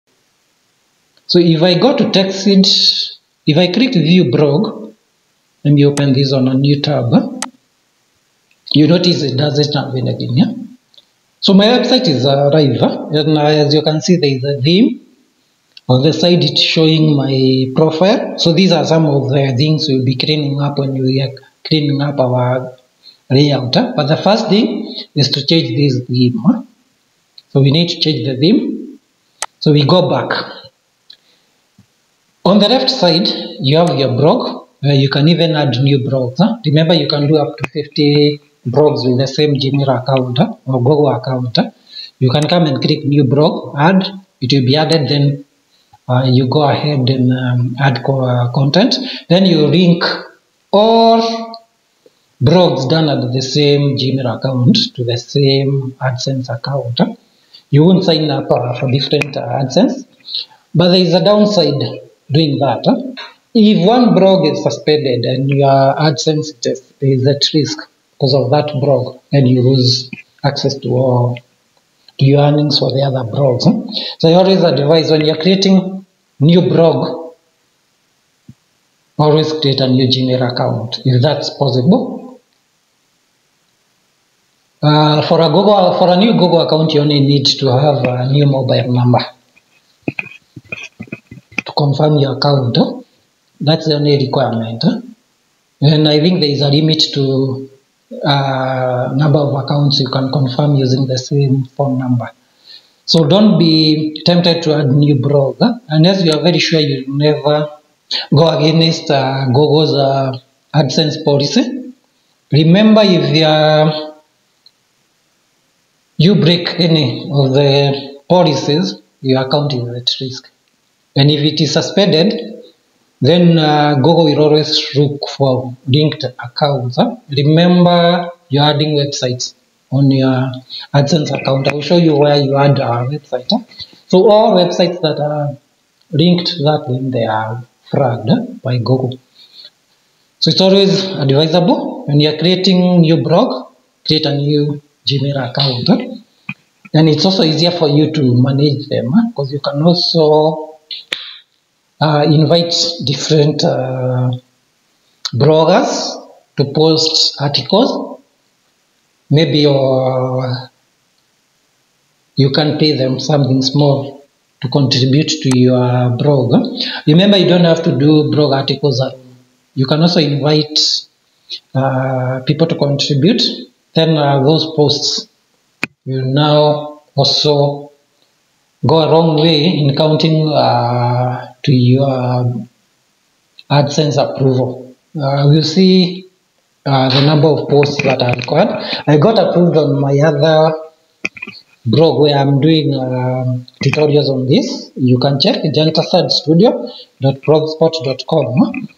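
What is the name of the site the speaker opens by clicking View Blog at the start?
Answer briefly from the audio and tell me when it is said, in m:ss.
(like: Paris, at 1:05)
TechSeed, at 0:02.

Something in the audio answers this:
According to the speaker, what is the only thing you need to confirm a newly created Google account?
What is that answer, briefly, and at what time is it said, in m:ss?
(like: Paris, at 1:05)
a new mobile number, at 1:28.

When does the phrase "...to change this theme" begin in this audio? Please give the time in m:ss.
0:25.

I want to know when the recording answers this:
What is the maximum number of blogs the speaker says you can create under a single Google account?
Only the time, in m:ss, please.
0:37.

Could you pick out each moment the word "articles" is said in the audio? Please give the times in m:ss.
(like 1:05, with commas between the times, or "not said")
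2:37, 2:48.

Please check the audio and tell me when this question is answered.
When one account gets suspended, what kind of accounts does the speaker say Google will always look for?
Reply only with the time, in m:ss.
2:05.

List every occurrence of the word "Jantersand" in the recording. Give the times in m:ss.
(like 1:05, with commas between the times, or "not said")
3:15.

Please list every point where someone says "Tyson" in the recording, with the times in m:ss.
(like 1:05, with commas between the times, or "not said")
not said.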